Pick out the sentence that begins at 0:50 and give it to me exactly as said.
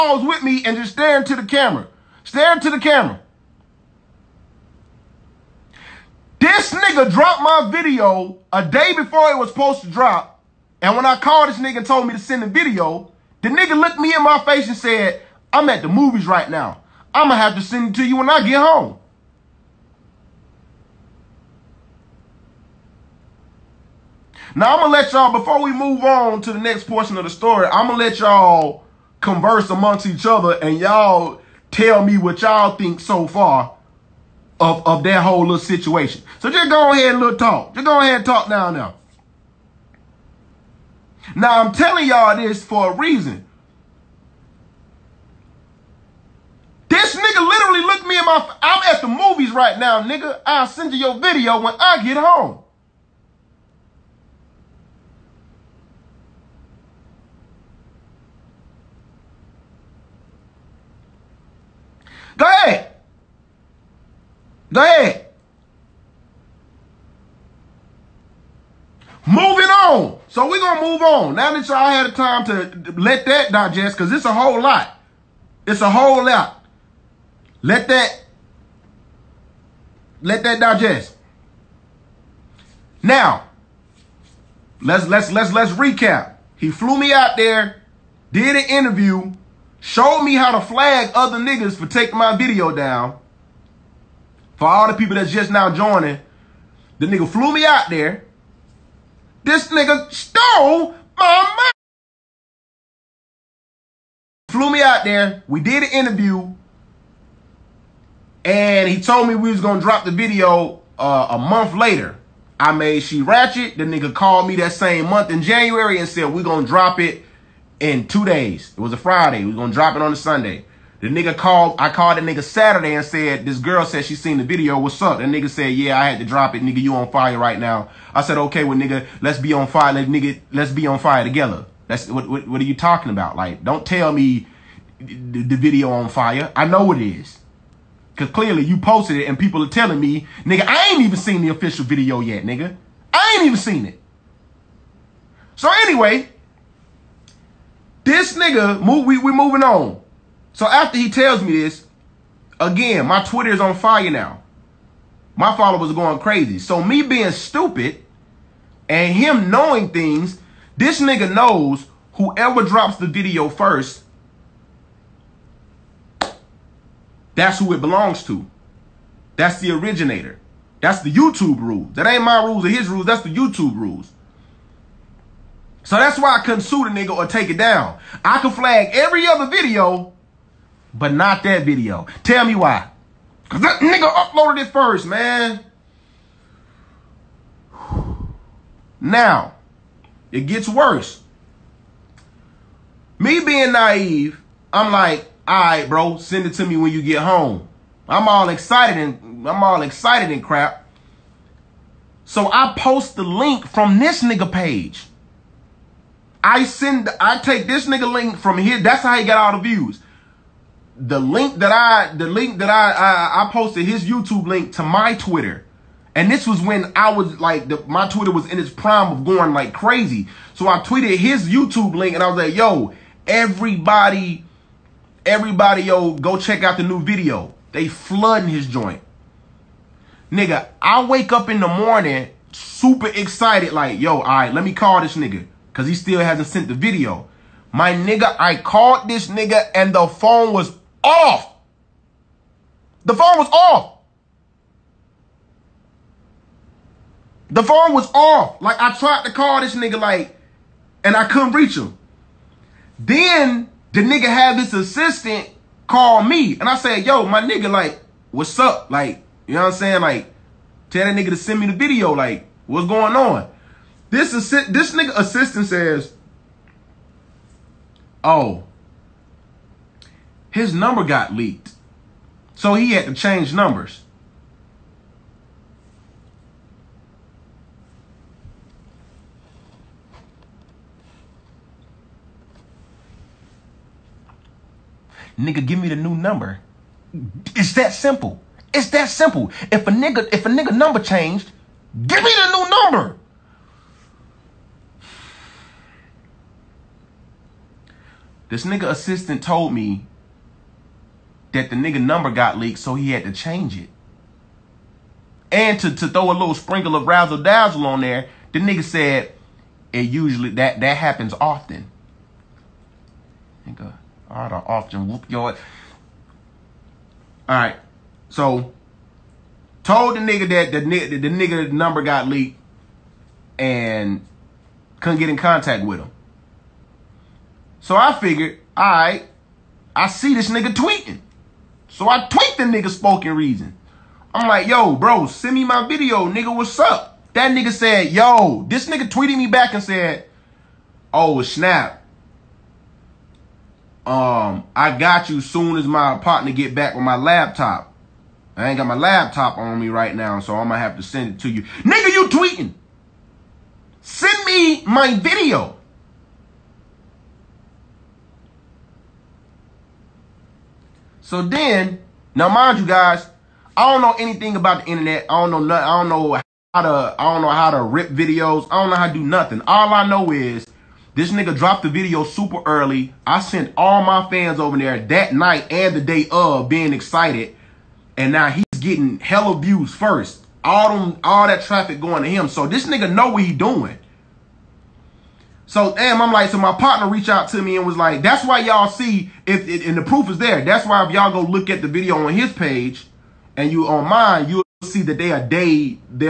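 I'll send you your video when I get home.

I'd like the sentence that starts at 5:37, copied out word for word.
That nigga said, yo, this nigga tweeted me back and said, oh, snap.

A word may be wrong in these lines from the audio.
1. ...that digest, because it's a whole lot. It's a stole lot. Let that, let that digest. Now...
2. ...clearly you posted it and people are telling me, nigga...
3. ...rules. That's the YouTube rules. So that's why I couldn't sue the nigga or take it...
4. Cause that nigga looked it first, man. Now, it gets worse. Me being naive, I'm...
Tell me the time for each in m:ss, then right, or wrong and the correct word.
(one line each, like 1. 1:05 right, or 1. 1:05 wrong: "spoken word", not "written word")
1. 1:13 wrong: "whole", not "stole"
2. 2:18 right
3. 2:52 right
4. 3:03 wrong: "uploaded", not "looked".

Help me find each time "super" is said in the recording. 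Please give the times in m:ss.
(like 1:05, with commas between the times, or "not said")
3:52, 6:12.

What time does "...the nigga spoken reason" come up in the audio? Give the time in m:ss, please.
5:32.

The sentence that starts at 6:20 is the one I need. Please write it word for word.
All them, all that traffic going to him.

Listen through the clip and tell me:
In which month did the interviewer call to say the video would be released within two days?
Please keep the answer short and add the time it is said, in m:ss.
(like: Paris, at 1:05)
January, at 1:55.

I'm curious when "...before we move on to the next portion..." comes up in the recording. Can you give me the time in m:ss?
0:25.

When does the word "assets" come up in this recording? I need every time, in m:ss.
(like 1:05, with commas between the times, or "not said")
not said.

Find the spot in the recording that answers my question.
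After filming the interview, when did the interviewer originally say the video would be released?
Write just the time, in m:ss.
1:51.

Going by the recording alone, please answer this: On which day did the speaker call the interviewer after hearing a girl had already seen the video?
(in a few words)
Saturday.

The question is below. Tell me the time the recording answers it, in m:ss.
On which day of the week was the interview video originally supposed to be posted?
2:00.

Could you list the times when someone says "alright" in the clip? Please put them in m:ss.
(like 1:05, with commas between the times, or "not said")
5:17, 5:28.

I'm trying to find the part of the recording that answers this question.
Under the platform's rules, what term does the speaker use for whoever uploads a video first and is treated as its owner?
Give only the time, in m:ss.
2:49.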